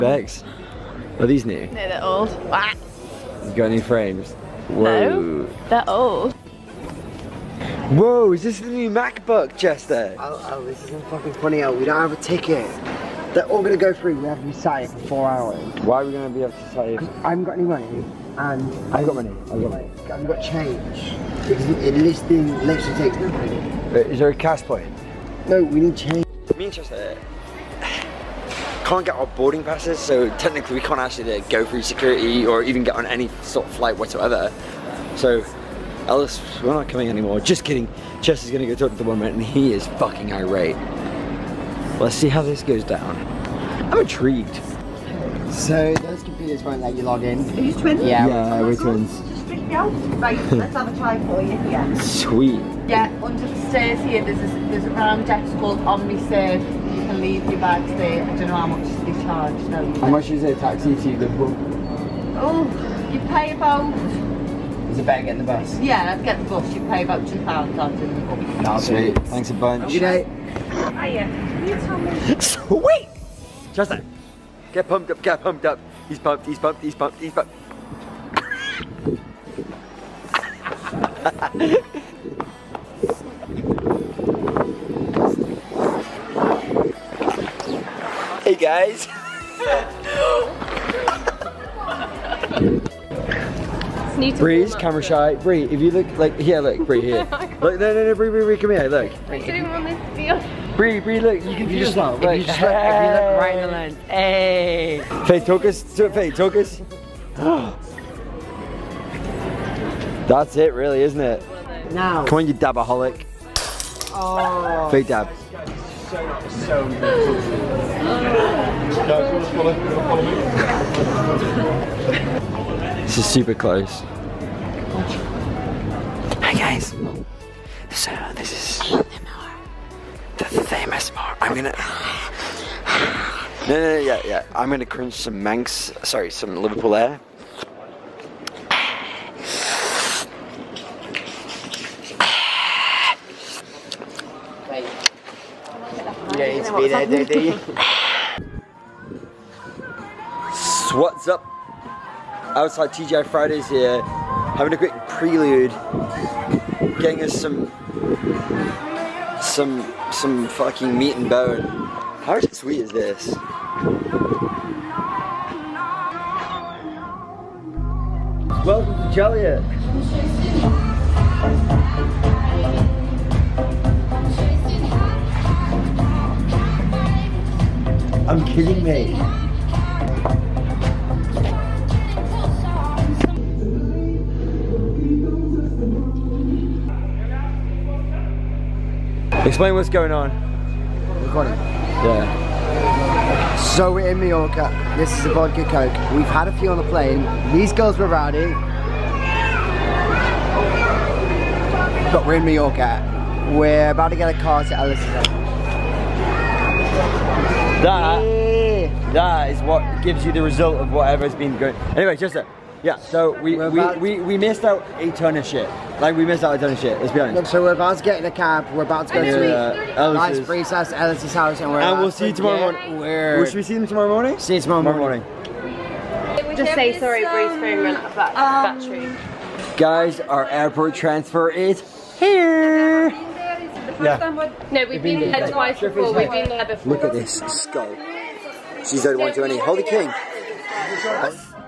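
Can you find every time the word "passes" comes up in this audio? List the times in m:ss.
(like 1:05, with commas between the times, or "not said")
0:29.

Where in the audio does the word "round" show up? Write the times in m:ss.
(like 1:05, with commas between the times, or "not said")
0:54.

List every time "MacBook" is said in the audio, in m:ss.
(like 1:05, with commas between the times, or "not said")
0:08.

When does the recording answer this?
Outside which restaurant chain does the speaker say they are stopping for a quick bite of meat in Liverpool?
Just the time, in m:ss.
2:32.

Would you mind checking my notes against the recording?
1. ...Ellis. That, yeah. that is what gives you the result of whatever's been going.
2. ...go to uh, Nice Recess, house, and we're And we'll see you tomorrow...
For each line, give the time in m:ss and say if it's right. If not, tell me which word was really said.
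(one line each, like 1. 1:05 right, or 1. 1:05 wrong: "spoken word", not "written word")
1. 3:24 right
2. 3:39 right.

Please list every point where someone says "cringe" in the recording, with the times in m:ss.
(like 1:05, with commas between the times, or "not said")
2:14.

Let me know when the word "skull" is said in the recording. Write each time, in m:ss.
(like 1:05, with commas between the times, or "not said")
3:57.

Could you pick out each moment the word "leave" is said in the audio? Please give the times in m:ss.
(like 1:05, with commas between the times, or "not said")
0:57.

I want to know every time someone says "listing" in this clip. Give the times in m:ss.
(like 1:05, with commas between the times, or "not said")
0:21.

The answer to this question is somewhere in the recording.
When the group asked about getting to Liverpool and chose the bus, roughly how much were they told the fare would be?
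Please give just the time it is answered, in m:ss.
1:07.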